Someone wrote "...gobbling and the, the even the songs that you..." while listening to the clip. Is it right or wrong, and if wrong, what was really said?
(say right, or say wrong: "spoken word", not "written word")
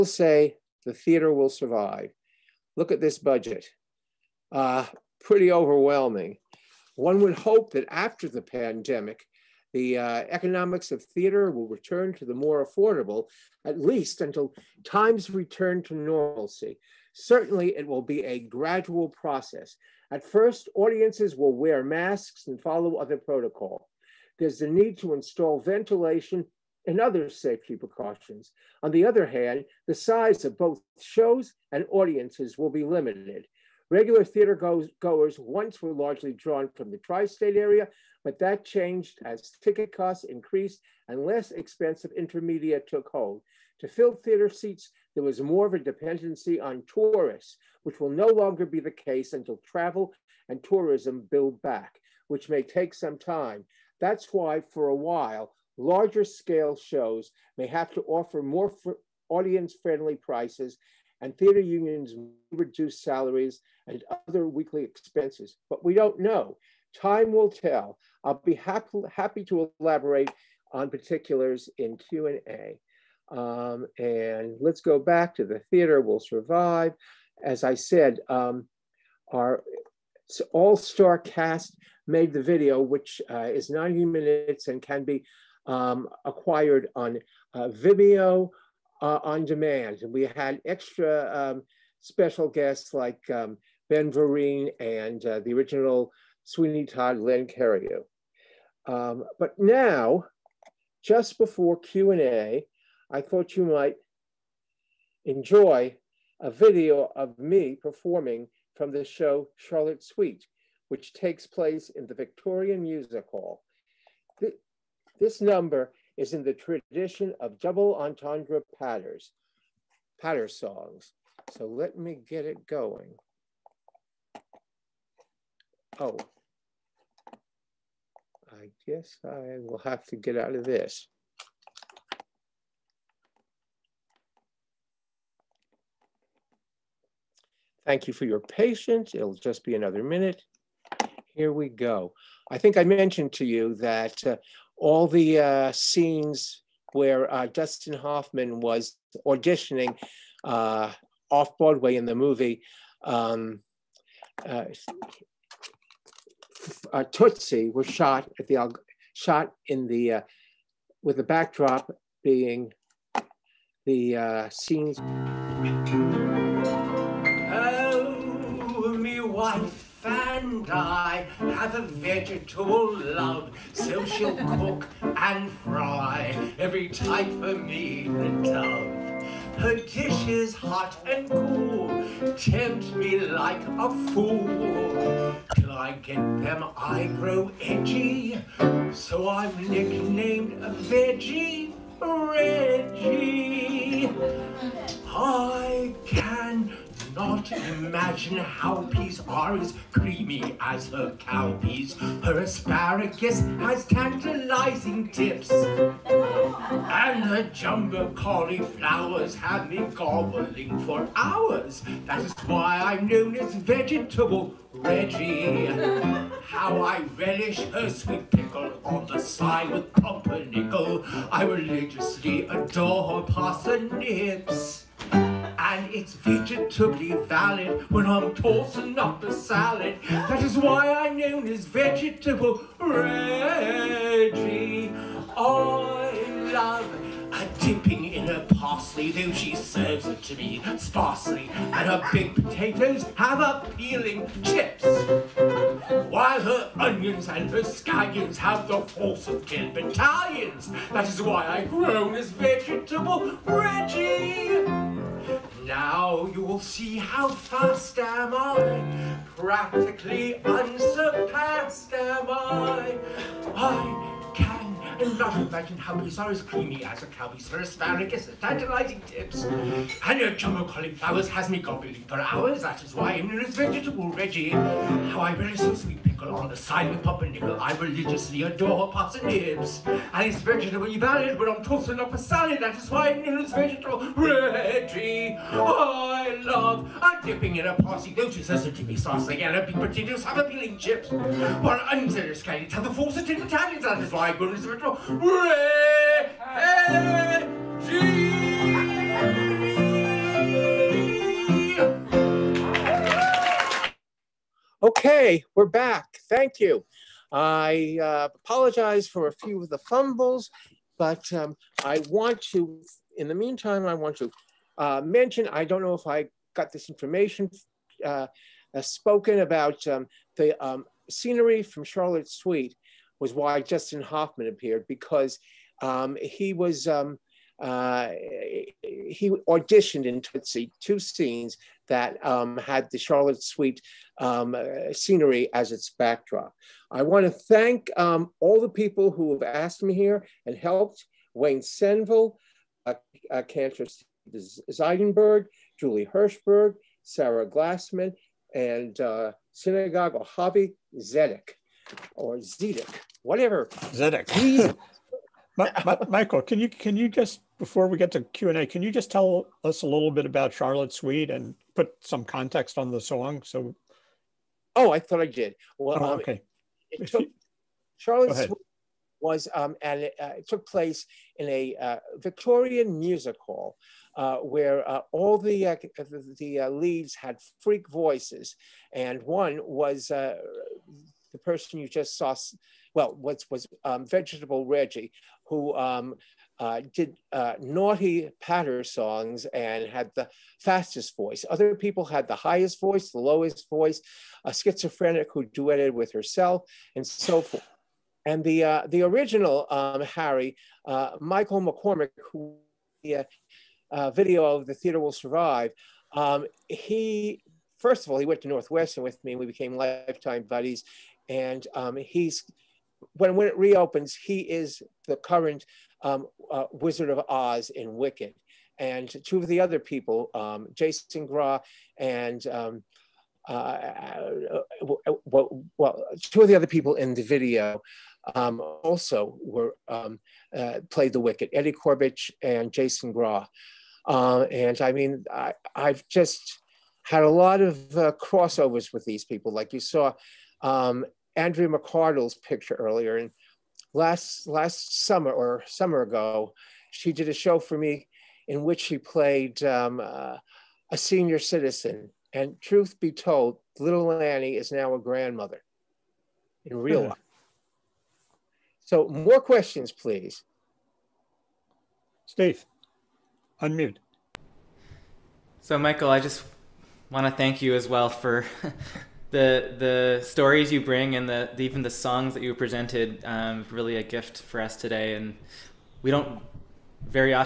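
wrong: "bring", not "gobbling".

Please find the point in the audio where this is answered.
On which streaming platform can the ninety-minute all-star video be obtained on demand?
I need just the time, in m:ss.
1:27.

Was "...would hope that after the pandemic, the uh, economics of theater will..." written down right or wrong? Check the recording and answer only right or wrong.
right.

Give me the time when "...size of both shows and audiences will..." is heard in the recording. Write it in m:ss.
0:29.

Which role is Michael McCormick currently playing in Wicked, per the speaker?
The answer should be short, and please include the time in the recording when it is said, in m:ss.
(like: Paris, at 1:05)
Wizard of Oz, at 6:56.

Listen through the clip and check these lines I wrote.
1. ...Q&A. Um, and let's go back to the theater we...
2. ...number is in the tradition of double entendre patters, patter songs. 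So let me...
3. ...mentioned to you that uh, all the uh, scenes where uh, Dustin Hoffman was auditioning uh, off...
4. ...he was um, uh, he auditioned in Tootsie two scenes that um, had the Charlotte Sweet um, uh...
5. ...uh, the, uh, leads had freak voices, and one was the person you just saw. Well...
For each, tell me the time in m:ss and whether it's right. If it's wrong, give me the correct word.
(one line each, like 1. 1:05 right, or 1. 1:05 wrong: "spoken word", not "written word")
1. 1:11 right
2. 1:55 right
3. 2:22 right
4. 5:26 right
5. 6:15 right.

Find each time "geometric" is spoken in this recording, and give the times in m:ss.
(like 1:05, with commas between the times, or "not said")
not said.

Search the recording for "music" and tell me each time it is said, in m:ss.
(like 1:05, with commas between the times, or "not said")
1:52, 6:12.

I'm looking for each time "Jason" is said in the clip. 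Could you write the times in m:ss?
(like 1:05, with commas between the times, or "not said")
7:00, 7:12.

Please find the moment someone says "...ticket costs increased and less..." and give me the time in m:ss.
0:39.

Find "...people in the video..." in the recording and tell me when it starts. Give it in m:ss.
7:06.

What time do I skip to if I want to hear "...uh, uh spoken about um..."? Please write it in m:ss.
5:18.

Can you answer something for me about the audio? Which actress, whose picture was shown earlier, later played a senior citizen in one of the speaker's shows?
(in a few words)
Andrea McArdle.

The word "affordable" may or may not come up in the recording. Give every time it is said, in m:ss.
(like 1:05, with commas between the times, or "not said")
0:12.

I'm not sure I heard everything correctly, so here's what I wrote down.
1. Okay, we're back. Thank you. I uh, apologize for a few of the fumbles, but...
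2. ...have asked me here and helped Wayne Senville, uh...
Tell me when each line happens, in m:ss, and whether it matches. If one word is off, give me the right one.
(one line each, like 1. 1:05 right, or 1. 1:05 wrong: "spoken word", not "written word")
1. 5:04 right
2. 5:39 right.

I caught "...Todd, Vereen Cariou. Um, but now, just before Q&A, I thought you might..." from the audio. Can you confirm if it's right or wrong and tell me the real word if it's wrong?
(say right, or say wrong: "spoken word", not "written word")
wrong: "Len", not "Vereen".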